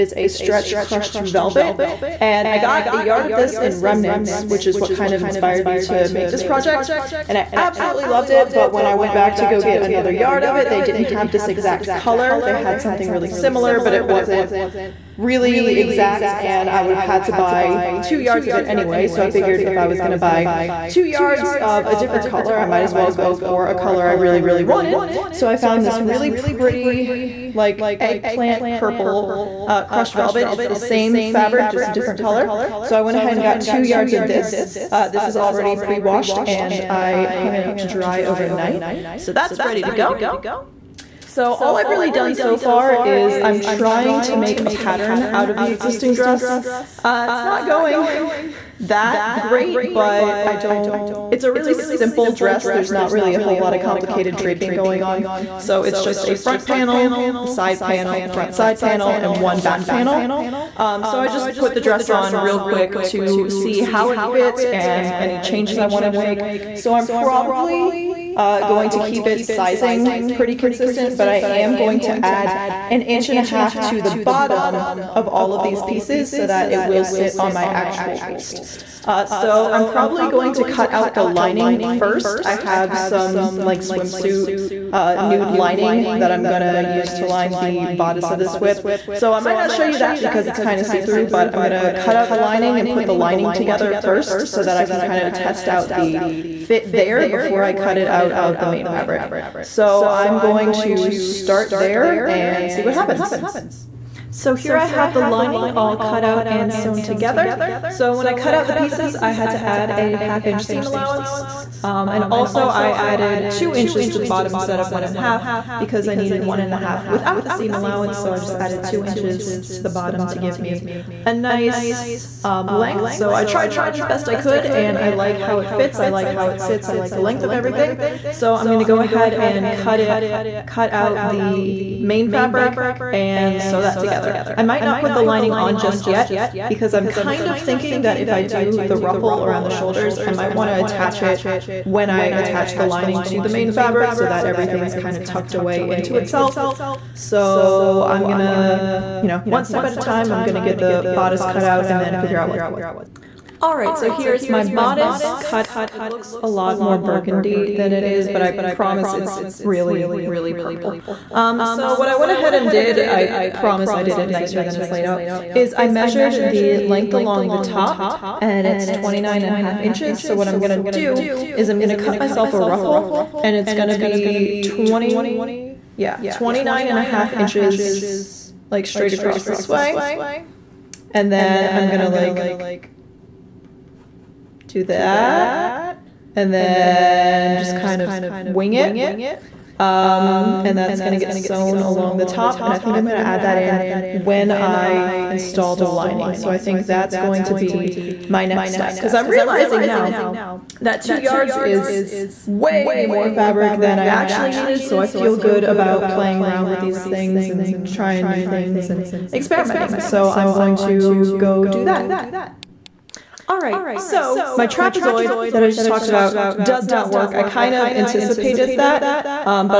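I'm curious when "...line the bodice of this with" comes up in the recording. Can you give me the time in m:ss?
1:27.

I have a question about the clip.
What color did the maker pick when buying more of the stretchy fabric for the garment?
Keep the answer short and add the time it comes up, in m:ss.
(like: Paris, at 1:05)
eggplant purple, at 0:27.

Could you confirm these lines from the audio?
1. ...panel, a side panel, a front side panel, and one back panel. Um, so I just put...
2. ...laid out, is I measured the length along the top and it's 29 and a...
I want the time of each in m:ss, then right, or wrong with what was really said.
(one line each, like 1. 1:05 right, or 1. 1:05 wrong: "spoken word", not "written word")
1. 0:56 right
2. 2:44 right.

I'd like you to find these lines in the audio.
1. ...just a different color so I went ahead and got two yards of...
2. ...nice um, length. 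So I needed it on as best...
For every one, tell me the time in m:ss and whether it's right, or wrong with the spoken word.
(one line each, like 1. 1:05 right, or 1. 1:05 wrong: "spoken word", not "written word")
1. 0:31 right
2. 2:01 wrong: "tried", not "needed".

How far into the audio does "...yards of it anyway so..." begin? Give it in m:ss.
0:18.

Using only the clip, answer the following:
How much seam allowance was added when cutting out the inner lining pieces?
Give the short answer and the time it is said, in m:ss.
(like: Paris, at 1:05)
a half inch, at 1:49.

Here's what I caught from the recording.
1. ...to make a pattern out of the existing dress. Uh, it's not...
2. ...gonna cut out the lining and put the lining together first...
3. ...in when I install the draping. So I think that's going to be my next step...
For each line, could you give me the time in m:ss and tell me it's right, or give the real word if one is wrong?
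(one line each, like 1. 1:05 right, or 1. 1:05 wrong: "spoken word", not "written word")
1. 0:44 right
2. 1:31 right
3. 3:13 wrong: "lining", not "draping".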